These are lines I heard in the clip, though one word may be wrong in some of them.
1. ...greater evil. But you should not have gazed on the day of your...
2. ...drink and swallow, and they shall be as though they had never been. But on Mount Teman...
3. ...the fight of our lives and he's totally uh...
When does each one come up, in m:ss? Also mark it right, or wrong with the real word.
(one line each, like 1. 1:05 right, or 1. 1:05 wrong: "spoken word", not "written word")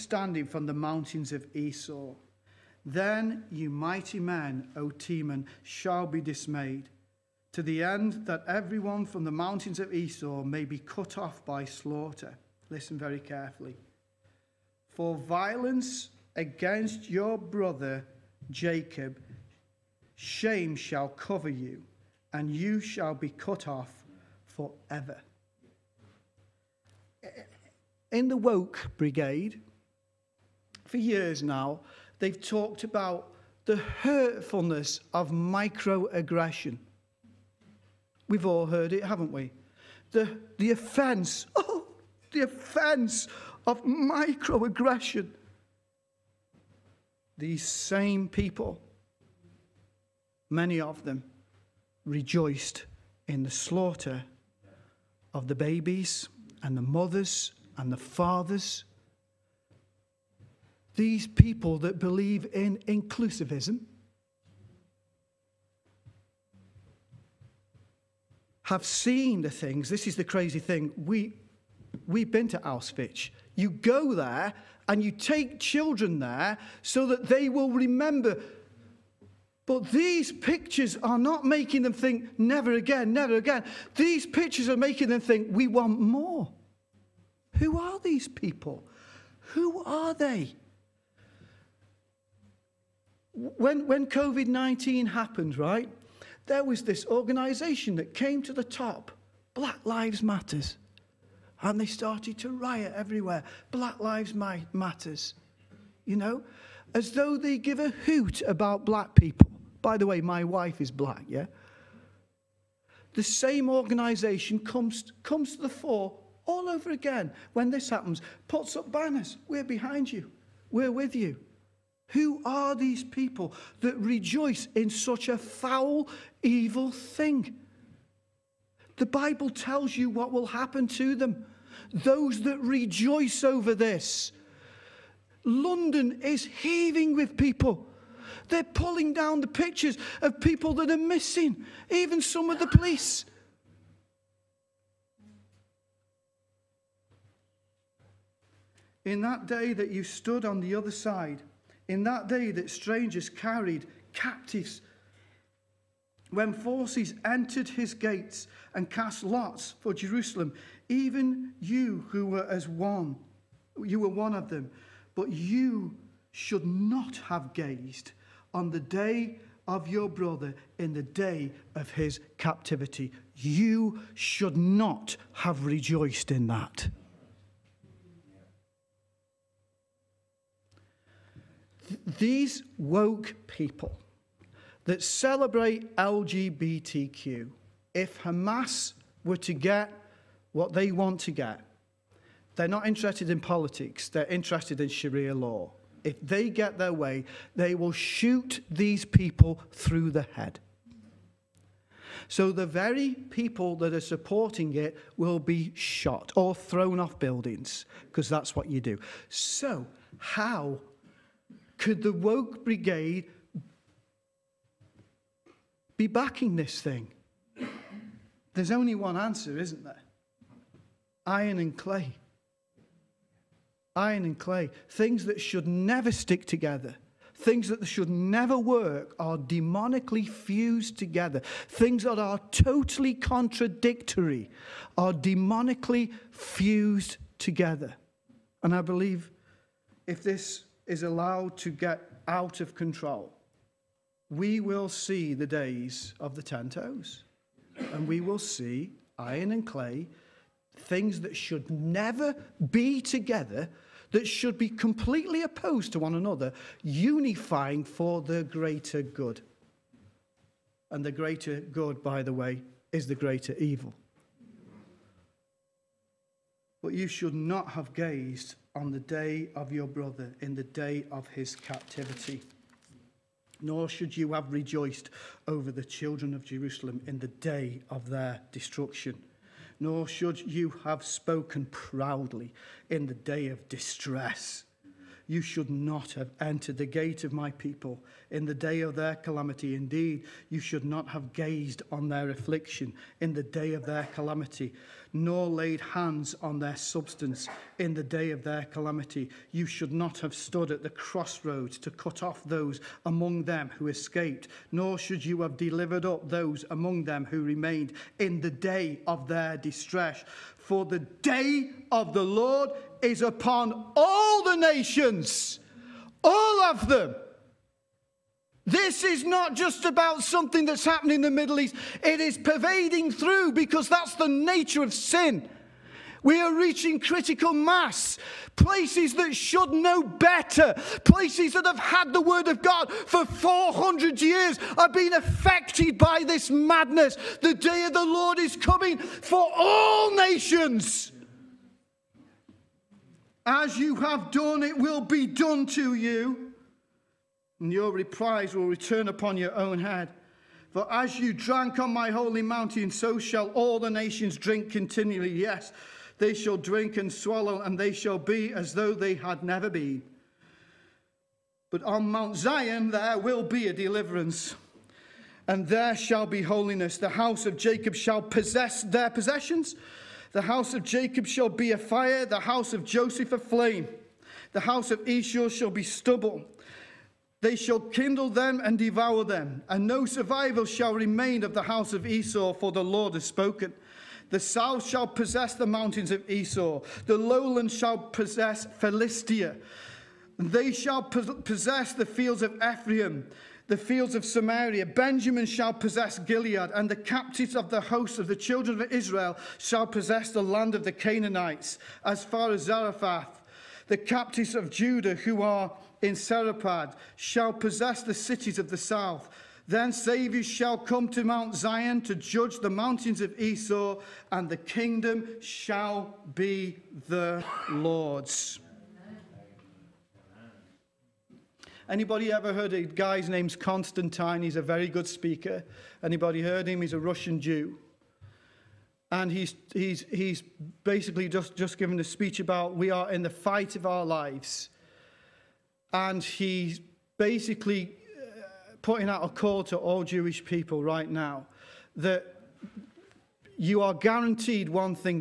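1. 4:23 right
2. 5:56 wrong: "Zion", not "Teman"
3. 7:13 wrong: "basically", not "totally".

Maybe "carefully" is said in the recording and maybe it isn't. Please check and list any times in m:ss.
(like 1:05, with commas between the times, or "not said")
0:13.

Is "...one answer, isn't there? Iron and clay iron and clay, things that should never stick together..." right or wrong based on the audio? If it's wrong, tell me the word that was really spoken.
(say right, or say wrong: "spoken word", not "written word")
right.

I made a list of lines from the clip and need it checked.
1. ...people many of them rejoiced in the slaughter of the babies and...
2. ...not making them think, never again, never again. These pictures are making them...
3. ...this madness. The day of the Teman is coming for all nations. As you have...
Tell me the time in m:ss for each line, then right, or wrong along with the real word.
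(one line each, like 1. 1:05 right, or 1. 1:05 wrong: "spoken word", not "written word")
1. 0:48 right
2. 1:21 right
3. 5:36 wrong: "Lord", not "Teman".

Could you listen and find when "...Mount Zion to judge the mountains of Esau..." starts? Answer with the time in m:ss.
6:51.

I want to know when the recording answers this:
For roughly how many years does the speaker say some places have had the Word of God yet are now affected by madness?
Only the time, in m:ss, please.
5:33.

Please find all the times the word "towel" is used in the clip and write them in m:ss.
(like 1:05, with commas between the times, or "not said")
not said.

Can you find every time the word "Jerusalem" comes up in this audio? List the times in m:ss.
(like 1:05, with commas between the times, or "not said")
2:39, 4:36.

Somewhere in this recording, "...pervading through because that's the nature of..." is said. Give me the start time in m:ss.
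5:22.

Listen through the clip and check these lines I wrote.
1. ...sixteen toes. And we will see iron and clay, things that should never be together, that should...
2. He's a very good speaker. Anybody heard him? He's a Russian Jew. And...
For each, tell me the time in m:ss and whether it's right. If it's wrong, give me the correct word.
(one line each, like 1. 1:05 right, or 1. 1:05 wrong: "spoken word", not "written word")
1. 4:06 wrong: "ten", not "sixteen"
2. 7:04 right.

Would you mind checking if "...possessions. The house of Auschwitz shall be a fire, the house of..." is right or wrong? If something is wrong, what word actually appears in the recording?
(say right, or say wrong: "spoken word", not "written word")
wrong: "Jacob", not "Auschwitz".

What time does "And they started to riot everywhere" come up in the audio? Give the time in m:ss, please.
1:41.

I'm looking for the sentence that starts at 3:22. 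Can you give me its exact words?
So the very people that are supporting it will be shot or thrown off buildings, because that's what you do.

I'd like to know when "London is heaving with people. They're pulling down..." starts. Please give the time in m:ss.
2:15.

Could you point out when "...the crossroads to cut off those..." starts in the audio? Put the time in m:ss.
5:00.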